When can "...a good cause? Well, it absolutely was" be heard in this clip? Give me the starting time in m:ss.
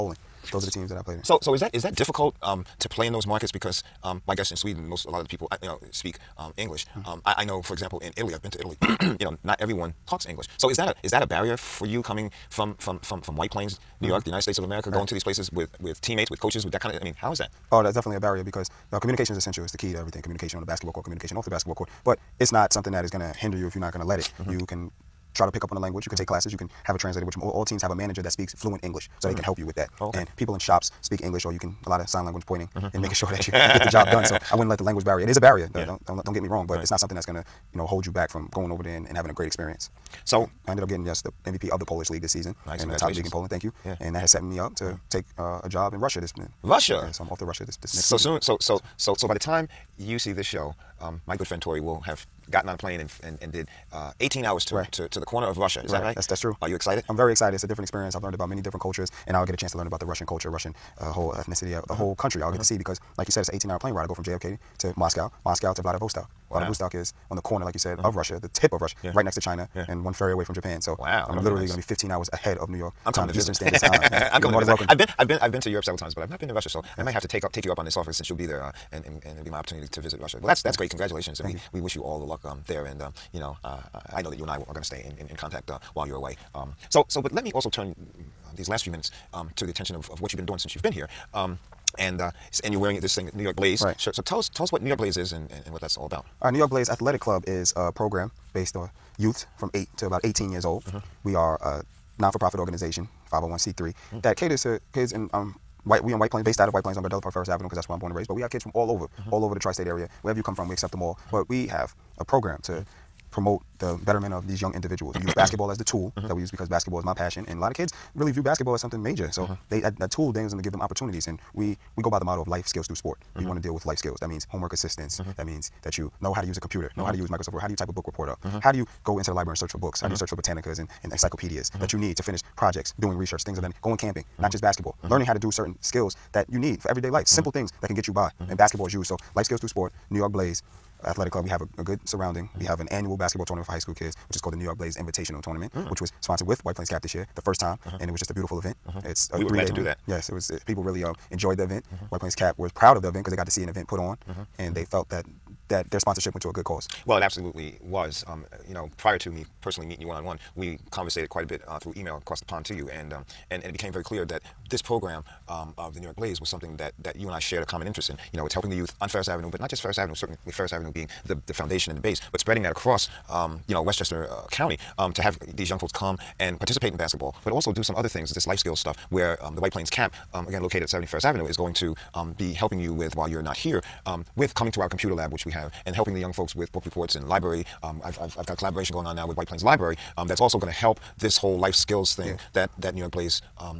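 2:36.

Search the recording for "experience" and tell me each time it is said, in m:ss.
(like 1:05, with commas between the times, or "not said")
0:39, 0:57.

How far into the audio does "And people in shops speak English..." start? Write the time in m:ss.
0:30.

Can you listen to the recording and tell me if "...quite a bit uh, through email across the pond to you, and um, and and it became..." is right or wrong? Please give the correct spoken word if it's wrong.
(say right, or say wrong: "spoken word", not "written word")
right.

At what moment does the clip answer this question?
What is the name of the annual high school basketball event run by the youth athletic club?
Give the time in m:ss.
2:24.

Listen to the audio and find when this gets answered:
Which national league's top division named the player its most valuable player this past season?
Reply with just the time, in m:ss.
0:41.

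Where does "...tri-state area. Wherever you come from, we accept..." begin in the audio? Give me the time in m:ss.
1:49.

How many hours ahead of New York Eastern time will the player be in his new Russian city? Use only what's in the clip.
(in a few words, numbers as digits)
15.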